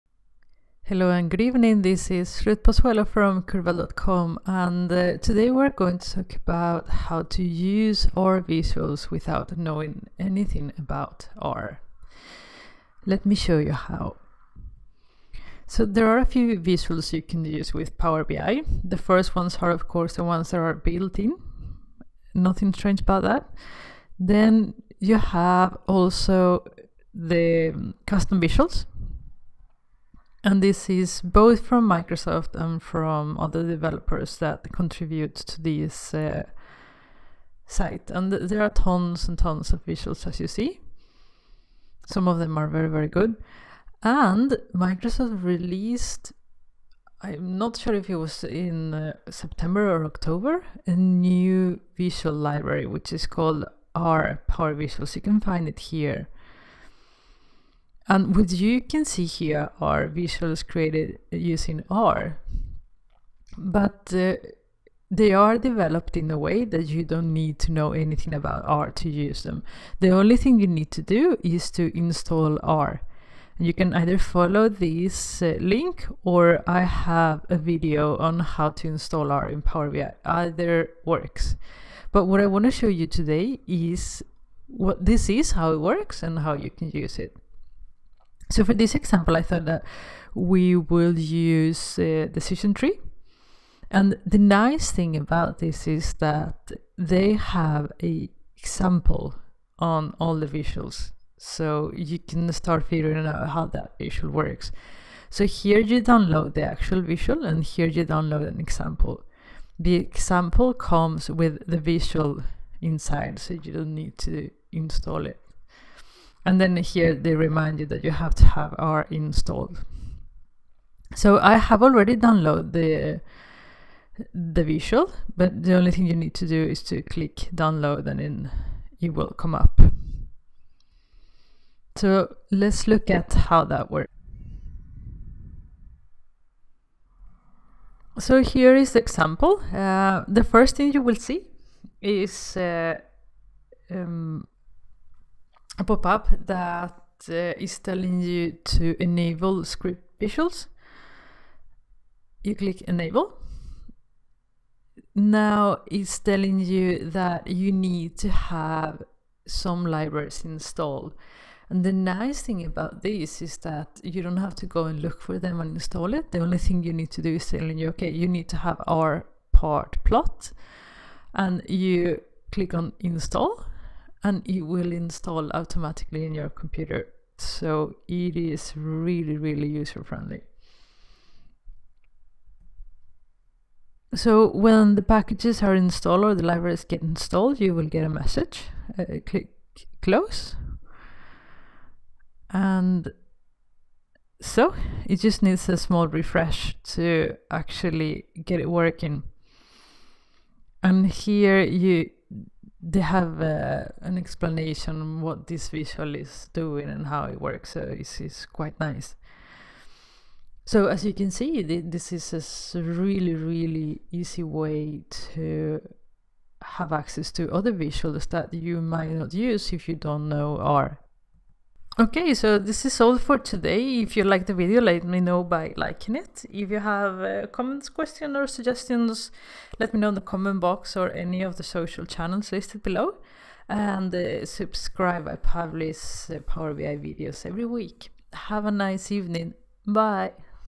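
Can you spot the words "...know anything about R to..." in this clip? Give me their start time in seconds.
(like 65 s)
67 s.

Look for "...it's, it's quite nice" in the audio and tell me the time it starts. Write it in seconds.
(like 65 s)
207 s.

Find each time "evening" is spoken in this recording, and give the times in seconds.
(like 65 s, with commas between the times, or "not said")
1 s, 239 s.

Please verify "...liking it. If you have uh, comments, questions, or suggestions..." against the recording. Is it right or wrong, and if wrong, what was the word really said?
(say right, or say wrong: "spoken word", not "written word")
right.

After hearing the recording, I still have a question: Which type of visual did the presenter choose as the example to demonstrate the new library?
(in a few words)
Decision tree.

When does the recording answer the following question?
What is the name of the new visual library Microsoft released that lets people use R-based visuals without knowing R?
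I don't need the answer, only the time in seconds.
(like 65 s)
53 s.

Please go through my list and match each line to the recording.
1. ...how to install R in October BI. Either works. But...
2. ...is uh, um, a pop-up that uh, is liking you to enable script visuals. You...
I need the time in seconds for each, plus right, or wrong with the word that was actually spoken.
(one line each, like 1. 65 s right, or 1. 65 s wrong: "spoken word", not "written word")
1. 78 s wrong: "Power", not "October"
2. 142 s wrong: "telling", not "liking".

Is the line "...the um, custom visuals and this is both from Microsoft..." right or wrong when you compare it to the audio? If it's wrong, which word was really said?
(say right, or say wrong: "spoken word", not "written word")
right.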